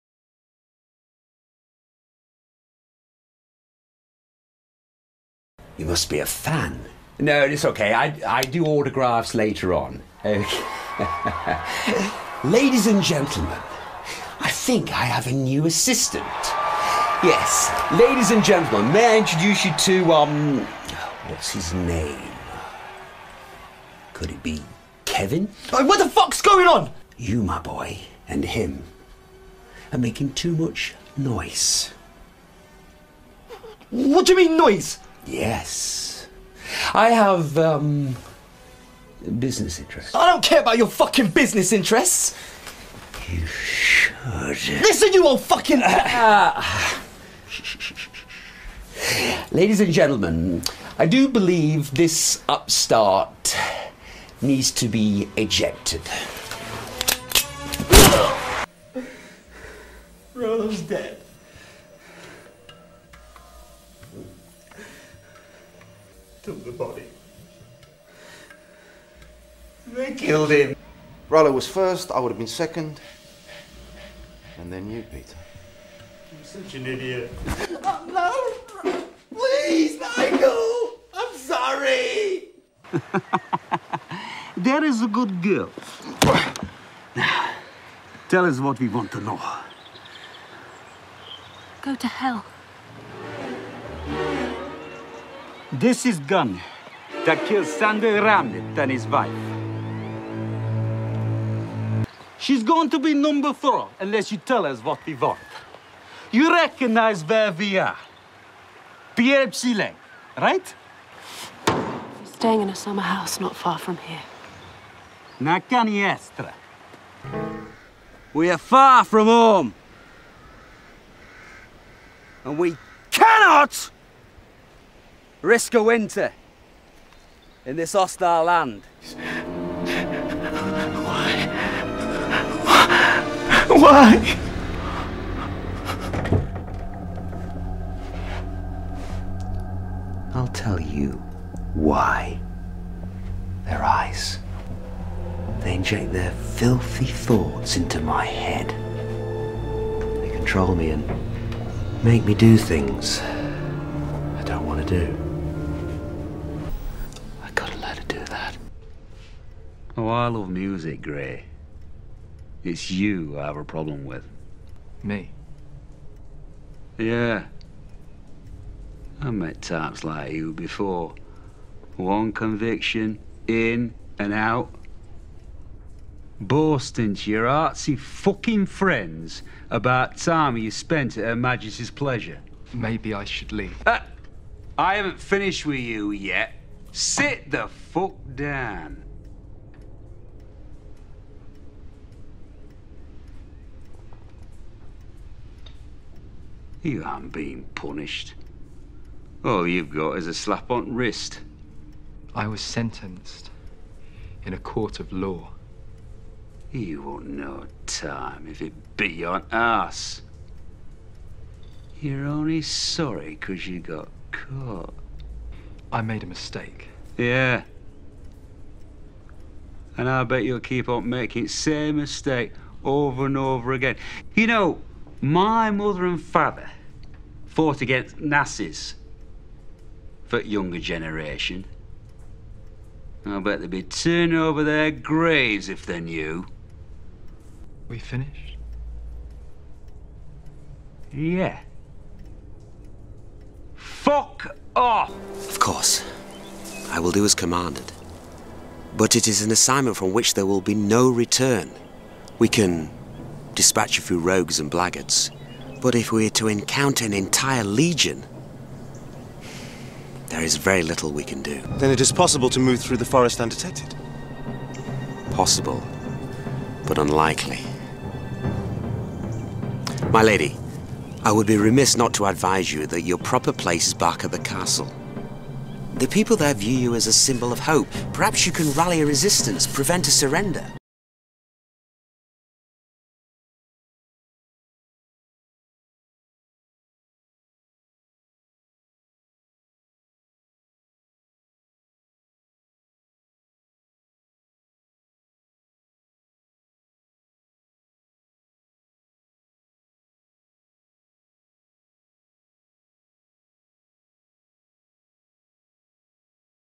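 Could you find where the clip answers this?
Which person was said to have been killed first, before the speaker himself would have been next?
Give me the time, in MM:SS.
01:11.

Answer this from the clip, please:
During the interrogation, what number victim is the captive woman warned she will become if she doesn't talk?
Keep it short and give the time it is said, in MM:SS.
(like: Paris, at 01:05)
4, at 01:43.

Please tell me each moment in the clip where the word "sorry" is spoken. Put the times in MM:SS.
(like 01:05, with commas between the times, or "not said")
01:21, 03:32.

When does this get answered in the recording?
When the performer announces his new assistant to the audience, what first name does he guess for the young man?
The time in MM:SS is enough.
00:25.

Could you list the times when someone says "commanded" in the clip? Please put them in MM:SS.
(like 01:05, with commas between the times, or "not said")
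04:07.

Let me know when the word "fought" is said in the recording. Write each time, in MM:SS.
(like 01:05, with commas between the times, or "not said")
03:47.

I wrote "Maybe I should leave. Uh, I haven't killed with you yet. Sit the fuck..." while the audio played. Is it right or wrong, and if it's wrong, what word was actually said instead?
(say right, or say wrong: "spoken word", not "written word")
wrong: "finished", not "killed".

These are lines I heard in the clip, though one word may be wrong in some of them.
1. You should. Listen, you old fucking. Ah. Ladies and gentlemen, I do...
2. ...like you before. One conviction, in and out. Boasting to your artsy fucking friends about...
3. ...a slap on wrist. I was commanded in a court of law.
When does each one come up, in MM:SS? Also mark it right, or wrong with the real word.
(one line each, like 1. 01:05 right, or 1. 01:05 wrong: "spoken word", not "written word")
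1. 00:43 right
2. 02:50 right
3. 03:20 wrong: "sentenced", not "commanded".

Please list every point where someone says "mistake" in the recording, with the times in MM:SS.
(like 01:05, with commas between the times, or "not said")
03:36, 03:41.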